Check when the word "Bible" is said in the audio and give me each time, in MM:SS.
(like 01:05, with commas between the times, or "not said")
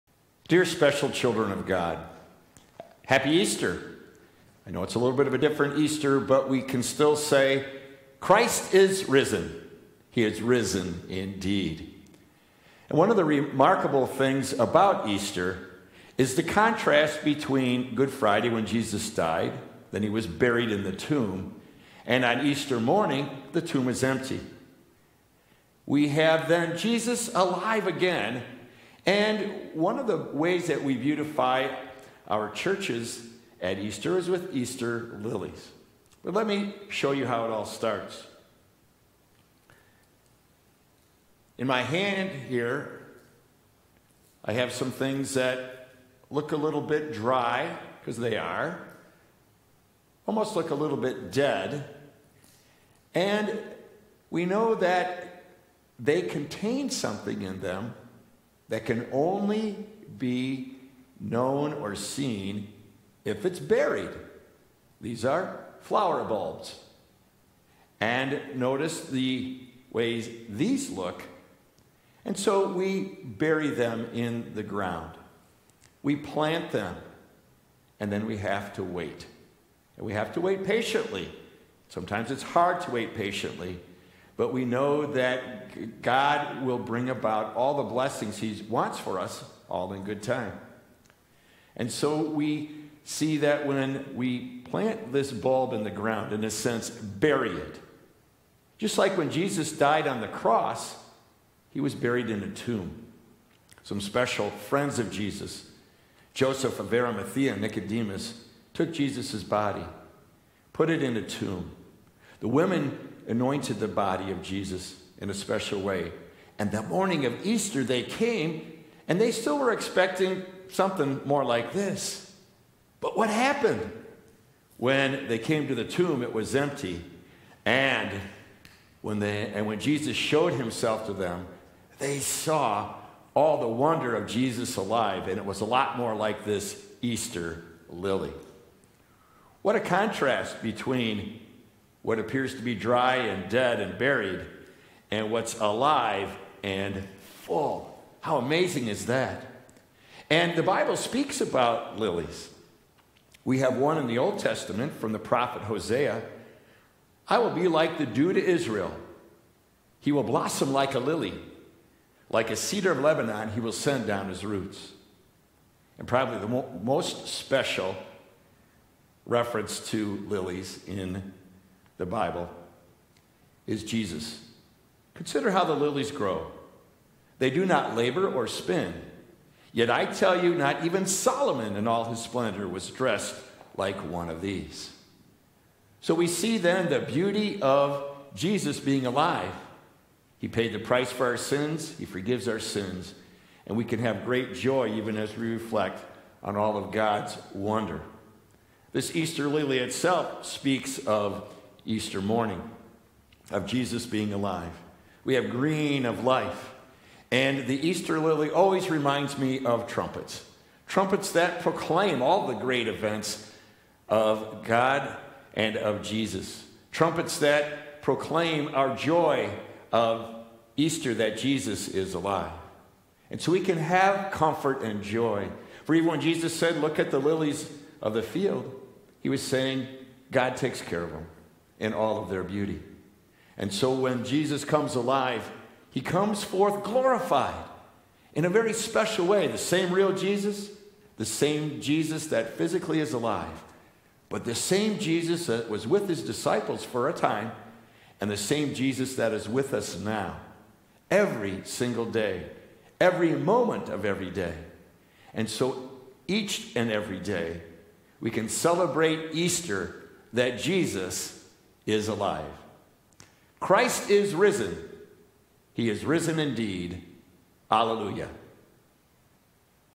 02:30, 02:52.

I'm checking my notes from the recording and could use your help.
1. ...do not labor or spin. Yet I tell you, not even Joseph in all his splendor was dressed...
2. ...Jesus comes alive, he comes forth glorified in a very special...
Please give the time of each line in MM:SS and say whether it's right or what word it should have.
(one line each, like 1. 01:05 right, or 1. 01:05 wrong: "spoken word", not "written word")
1. 02:57 wrong: "Solomon", not "Joseph"
2. 03:54 right.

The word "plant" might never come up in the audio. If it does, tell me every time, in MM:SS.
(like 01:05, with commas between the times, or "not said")
01:16, 01:34.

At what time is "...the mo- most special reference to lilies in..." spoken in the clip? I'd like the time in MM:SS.
02:46.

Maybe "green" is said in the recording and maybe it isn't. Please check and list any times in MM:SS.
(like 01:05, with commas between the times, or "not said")
03:25.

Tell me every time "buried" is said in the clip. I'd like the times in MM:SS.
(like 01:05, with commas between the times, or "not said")
00:20, 01:03, 01:41, 02:23.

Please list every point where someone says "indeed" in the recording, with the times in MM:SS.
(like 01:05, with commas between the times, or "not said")
00:11, 04:26.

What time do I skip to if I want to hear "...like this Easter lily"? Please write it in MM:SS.
02:16.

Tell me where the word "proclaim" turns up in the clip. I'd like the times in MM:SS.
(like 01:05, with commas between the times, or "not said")
03:31, 03:38.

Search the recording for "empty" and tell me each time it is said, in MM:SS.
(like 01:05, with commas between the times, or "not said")
00:24, 02:06.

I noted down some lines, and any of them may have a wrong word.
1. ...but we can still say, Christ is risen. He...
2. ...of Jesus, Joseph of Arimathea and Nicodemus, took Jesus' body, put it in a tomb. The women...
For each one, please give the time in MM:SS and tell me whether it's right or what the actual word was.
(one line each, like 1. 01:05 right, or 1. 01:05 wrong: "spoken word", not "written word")
1. 00:06 right
2. 01:44 right.